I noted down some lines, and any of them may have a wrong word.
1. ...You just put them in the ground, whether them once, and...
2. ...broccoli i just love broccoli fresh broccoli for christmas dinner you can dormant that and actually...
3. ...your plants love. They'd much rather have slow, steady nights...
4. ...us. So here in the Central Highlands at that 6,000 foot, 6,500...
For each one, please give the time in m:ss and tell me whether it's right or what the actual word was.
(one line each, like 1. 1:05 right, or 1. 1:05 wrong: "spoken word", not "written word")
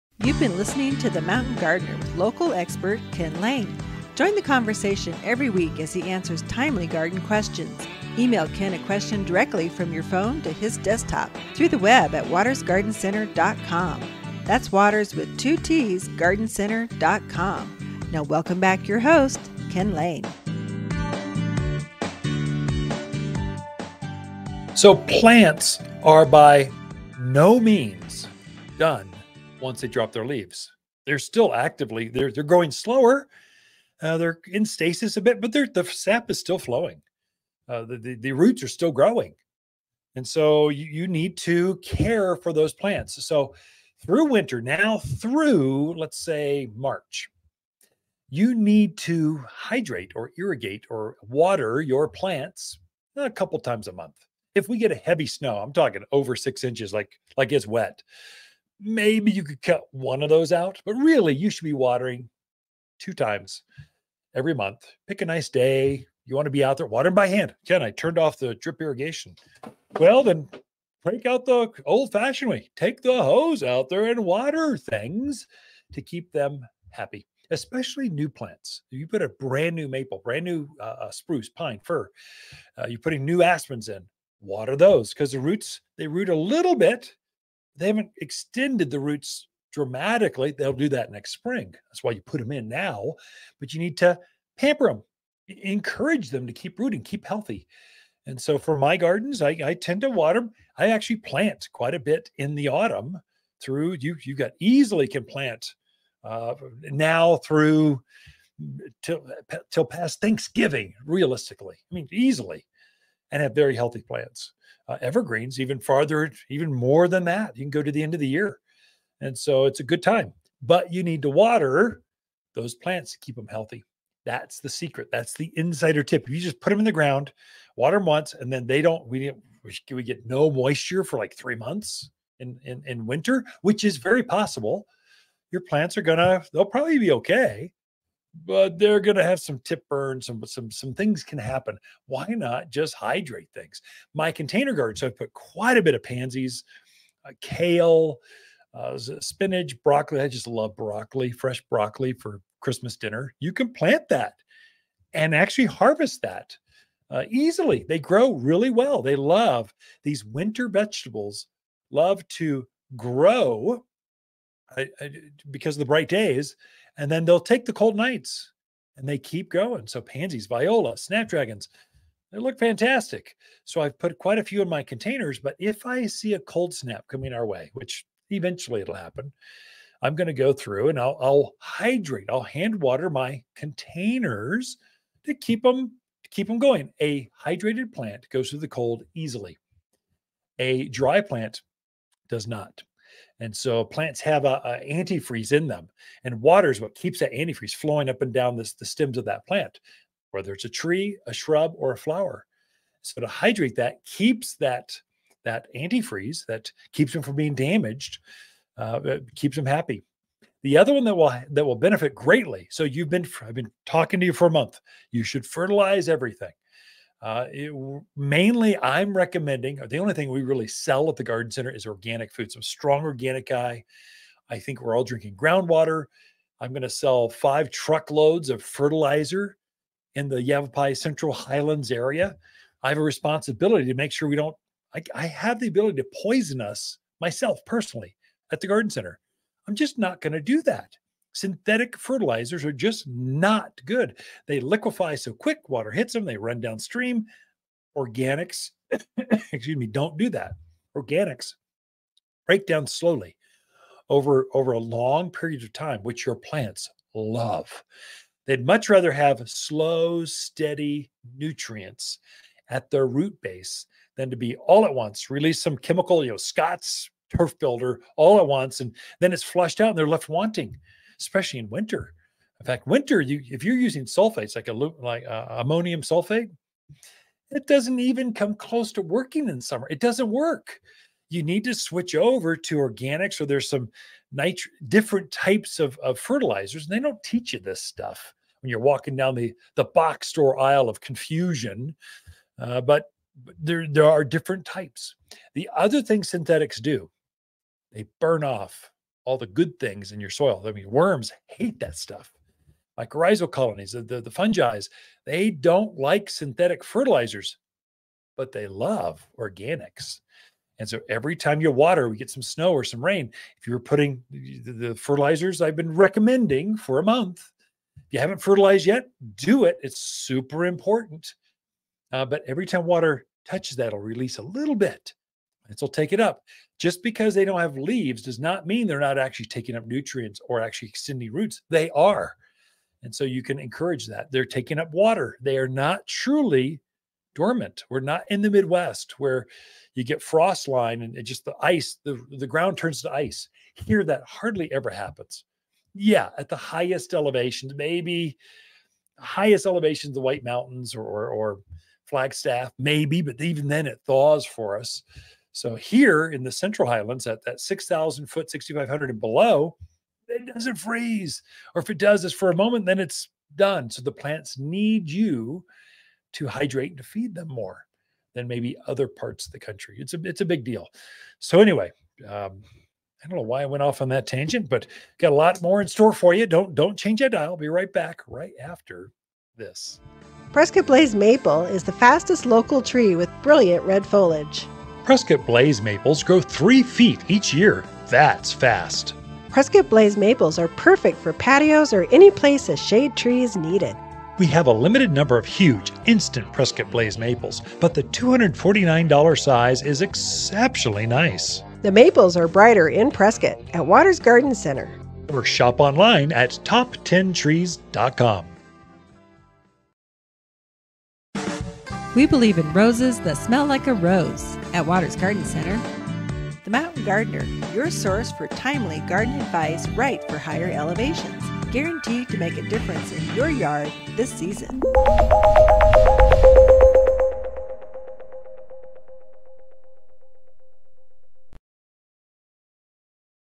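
1. 2:06 wrong: "water", not "whether"
2. 2:29 wrong: "plant", not "dormant"
3. 4:16 wrong: "nutrients", not "nights"
4. 5:54 right.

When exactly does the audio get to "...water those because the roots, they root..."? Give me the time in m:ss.
1:24.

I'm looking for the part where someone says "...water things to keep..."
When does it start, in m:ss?
1:14.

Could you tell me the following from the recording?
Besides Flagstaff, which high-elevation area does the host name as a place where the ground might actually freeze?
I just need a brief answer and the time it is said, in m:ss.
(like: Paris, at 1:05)
White Mountains, at 5:50.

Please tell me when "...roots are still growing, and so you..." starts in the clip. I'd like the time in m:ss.
0:38.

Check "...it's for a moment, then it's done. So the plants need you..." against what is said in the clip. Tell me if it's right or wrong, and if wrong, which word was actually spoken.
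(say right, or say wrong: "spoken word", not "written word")
right.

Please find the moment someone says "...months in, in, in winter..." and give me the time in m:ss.
2:11.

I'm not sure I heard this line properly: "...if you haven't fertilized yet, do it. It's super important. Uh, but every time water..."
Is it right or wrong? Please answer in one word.
right.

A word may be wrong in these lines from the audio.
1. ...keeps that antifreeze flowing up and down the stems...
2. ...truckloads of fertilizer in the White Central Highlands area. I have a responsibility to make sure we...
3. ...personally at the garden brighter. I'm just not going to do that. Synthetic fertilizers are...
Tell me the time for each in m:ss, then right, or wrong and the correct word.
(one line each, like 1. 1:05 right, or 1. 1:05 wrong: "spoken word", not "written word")
1. 3:16 right
2. 3:47 wrong: "Yavapai", not "White"
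3. 3:57 wrong: "center", not "brighter".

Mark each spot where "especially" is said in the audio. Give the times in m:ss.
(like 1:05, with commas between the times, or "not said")
1:17, 4:31.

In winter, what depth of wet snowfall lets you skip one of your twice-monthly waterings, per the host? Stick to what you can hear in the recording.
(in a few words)
over 6 inches.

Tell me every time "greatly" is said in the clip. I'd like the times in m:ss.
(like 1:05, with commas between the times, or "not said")
3:32.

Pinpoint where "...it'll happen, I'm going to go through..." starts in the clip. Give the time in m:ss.
2:58.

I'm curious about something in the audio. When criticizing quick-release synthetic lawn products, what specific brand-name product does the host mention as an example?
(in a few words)
Scott's Turf Builder.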